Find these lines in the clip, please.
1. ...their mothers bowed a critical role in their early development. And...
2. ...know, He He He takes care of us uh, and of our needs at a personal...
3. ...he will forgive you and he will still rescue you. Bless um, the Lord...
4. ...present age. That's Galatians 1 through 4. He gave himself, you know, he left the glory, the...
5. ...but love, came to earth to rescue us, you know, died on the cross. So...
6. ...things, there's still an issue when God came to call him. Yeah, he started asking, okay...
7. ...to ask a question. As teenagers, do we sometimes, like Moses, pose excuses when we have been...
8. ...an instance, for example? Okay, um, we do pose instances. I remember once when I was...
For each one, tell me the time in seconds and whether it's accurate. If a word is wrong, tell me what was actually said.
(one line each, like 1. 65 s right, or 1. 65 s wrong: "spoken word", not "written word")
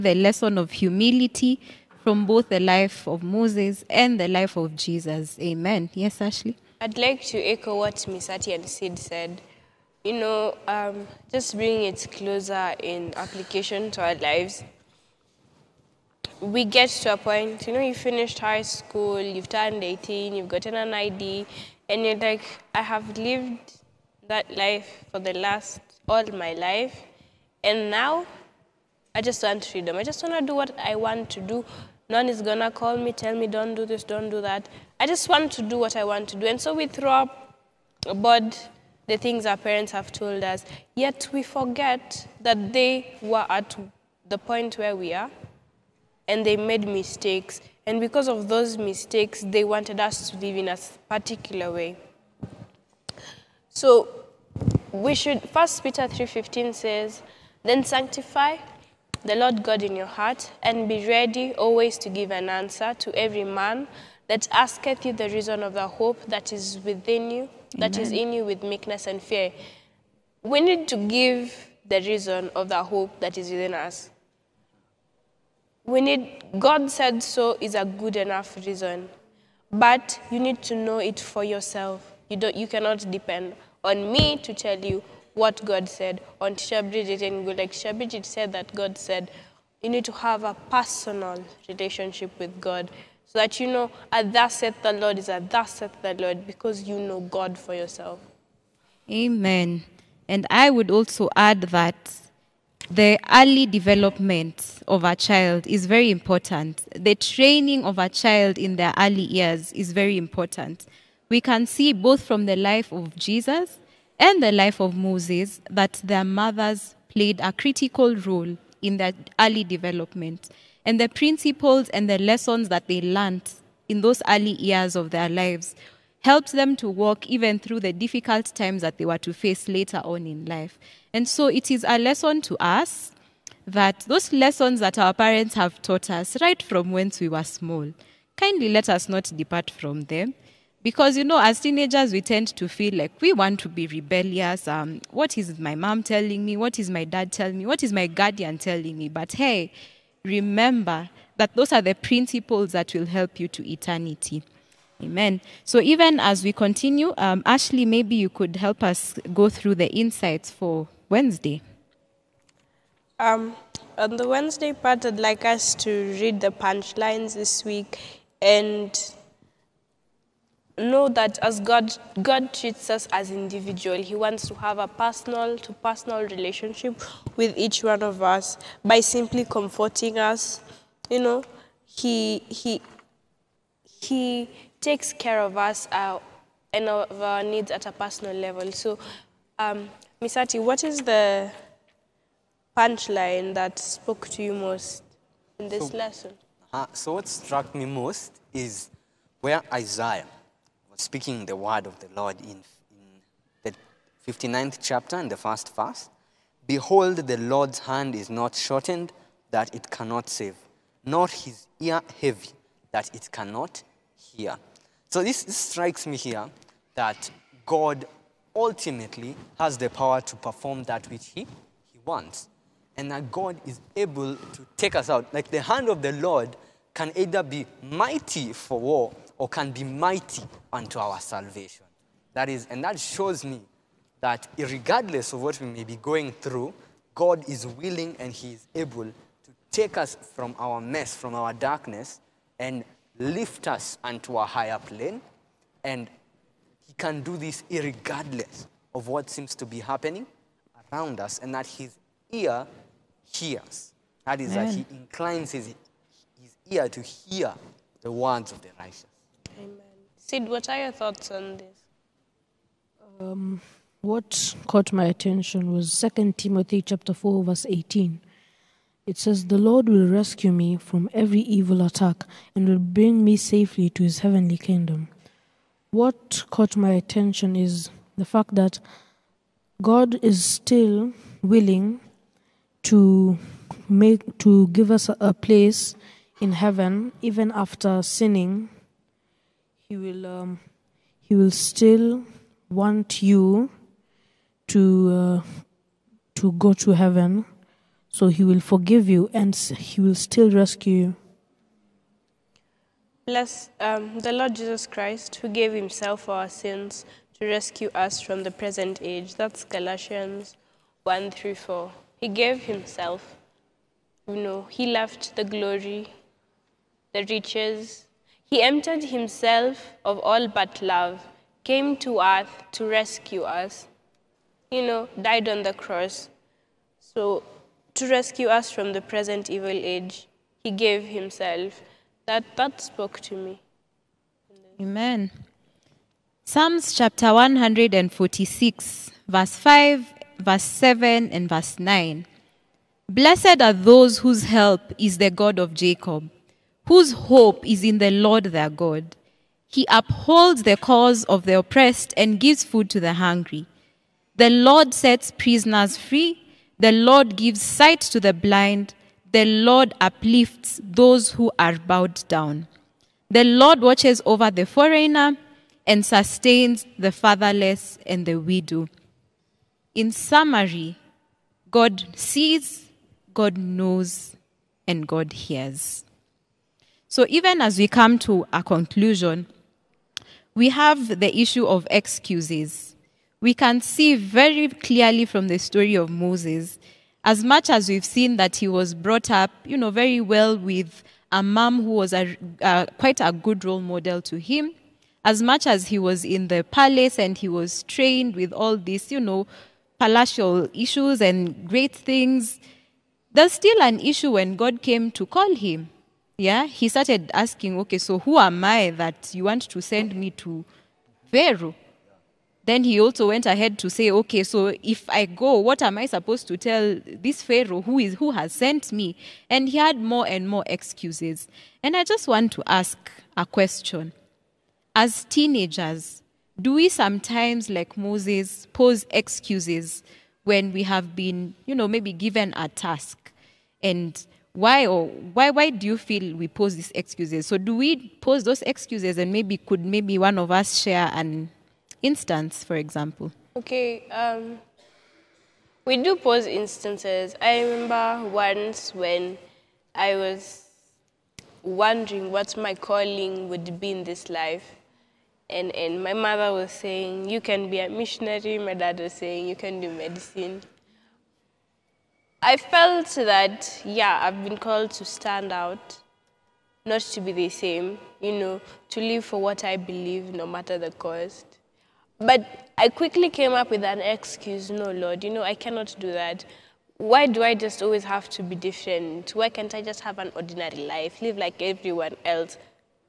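1. 116 s wrong: "played", not "bowed"
2. 181 s right
3. 298 s right
4. 308 s right
5. 320 s right
6. 401 s right
7. 422 s right
8. 441 s right.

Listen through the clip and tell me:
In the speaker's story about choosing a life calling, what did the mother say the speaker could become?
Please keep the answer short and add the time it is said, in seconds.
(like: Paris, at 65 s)
A missionary, at 457 s.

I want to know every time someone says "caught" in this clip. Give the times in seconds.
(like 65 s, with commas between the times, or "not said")
264 s, 276 s.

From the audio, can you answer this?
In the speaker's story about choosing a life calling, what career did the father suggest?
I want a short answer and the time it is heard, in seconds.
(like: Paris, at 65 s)
Medicine, at 459 s.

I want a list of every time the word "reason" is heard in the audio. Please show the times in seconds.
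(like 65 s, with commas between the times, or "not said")
65 s, 72 s, 78 s.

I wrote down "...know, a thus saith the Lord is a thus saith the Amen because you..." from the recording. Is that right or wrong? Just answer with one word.
wrong.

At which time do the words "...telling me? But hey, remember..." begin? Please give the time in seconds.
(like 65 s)
148 s.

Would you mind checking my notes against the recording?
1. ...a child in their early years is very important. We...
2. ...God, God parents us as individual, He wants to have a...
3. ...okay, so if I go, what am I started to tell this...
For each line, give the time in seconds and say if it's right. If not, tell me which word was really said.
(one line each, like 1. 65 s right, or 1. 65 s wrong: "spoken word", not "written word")
1. 107 s right
2. 171 s wrong: "treats", not "parents"
3. 414 s wrong: "supposed", not "started".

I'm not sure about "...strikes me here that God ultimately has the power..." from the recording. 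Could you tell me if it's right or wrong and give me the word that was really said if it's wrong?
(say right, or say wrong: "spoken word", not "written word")
right.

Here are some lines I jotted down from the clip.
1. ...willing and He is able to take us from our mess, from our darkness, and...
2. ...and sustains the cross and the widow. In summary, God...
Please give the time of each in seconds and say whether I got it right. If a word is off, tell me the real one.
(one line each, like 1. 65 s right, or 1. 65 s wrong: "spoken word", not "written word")
1. 237 s right
2. 365 s wrong: "fatherless", not "cross".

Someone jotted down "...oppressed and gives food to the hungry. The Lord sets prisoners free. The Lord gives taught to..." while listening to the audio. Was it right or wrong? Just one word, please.
wrong.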